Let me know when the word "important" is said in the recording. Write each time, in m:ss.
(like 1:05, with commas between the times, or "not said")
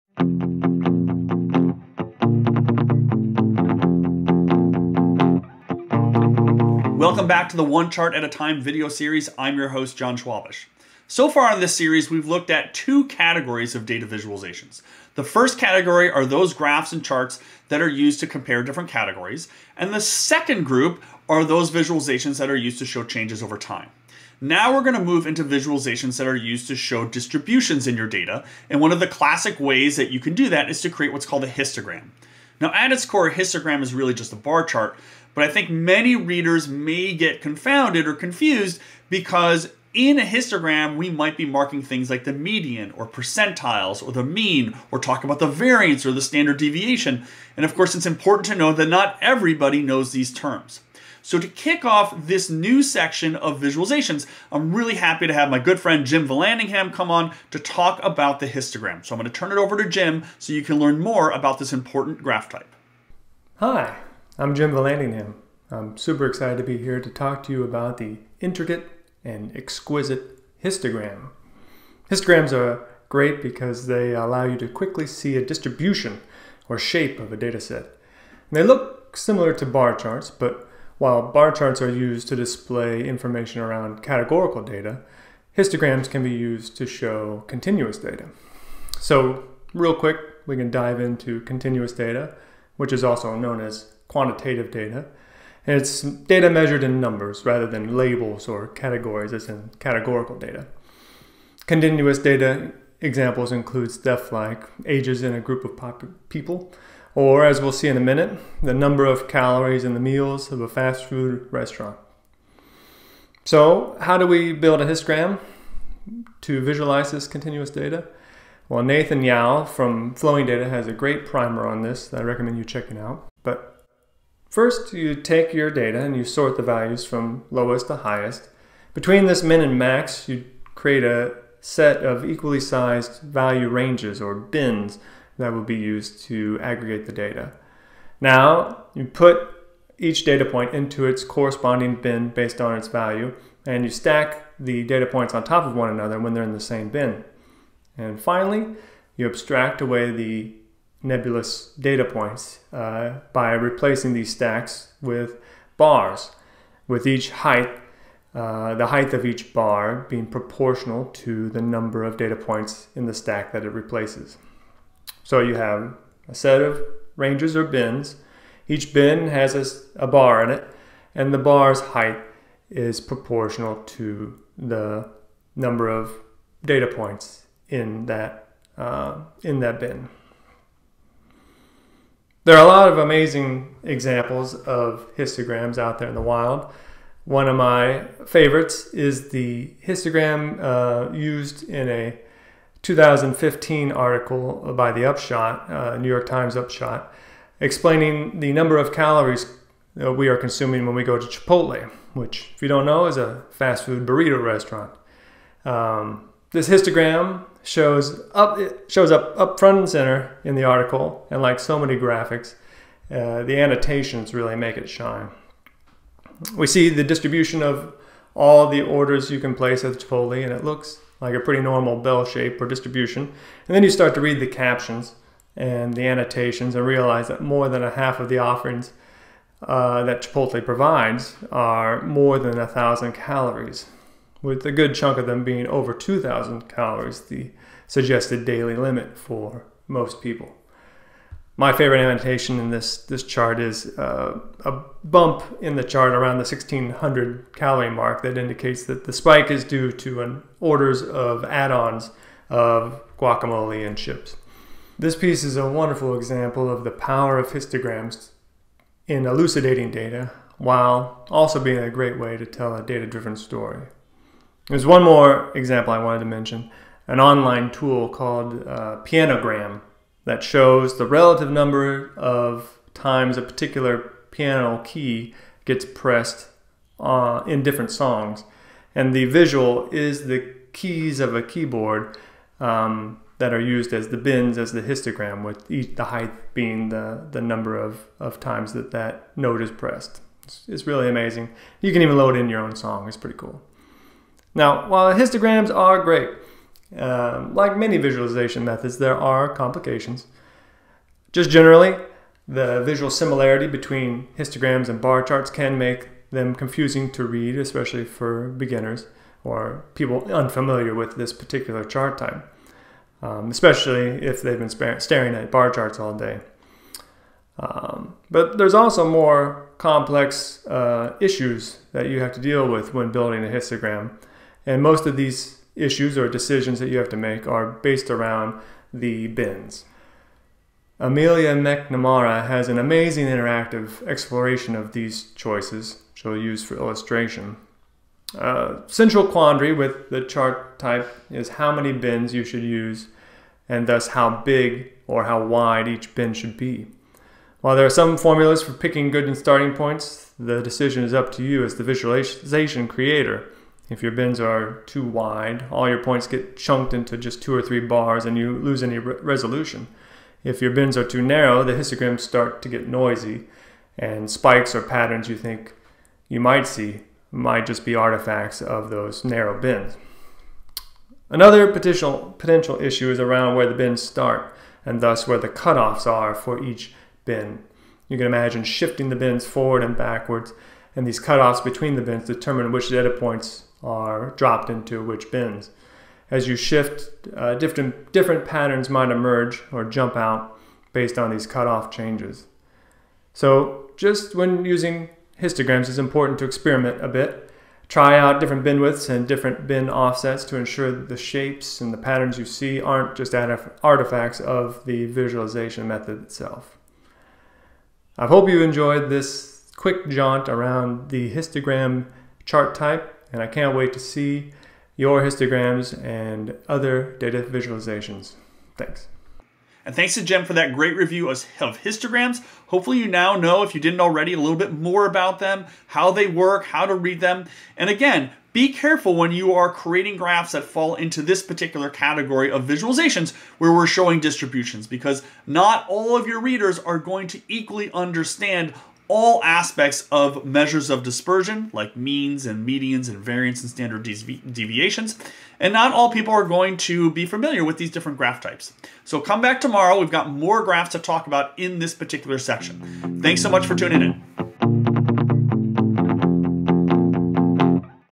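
0:48, 1:01, 6:35.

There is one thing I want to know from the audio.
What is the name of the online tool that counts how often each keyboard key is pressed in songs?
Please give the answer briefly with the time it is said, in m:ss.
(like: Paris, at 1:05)
Pianogram, at 4:29.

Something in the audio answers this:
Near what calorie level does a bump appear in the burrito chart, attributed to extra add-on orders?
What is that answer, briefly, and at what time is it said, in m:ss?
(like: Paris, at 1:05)
1600, at 4:06.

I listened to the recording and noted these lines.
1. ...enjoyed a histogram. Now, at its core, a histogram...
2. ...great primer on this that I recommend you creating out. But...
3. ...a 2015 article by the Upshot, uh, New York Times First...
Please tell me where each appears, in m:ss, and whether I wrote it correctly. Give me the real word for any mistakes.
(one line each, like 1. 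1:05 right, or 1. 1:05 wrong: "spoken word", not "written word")
1. 0:31 wrong: "called", not "enjoyed"
2. 2:00 wrong: "checking", not "creating"
3. 3:11 wrong: "Upshot", not "First".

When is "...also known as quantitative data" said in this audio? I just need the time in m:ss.
1:33.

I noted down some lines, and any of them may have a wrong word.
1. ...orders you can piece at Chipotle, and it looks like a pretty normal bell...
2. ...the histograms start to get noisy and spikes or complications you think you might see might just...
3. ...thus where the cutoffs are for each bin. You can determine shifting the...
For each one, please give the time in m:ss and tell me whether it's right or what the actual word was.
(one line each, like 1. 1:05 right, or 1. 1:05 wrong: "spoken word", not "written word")
1. 3:38 wrong: "place", not "piece"
2. 6:01 wrong: "patterns", not "complications"
3. 6:15 wrong: "imagine", not "determine".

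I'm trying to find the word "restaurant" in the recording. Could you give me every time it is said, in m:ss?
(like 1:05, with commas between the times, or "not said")
1:51, 3:24.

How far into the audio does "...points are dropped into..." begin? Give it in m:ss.
6:23.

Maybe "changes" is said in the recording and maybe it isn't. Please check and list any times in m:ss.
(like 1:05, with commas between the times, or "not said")
0:23, 6:31.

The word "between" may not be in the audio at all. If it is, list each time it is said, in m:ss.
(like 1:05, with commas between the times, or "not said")
2:08, 5:03, 6:21.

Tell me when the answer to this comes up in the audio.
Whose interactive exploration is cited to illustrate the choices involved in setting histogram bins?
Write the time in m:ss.
5:30.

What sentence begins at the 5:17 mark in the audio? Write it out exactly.
Um, but there's also more complex uh, issues that you have to deal with when building a histogram.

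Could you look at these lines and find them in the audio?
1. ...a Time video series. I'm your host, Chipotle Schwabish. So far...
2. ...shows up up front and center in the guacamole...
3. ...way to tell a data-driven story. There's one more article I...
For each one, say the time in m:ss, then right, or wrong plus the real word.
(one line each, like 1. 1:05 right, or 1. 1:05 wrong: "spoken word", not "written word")
1. 0:08 wrong: "Jon", not "Chipotle"
2. 3:28 wrong: "article", not "guacamole"
3. 4:22 wrong: "example", not "article".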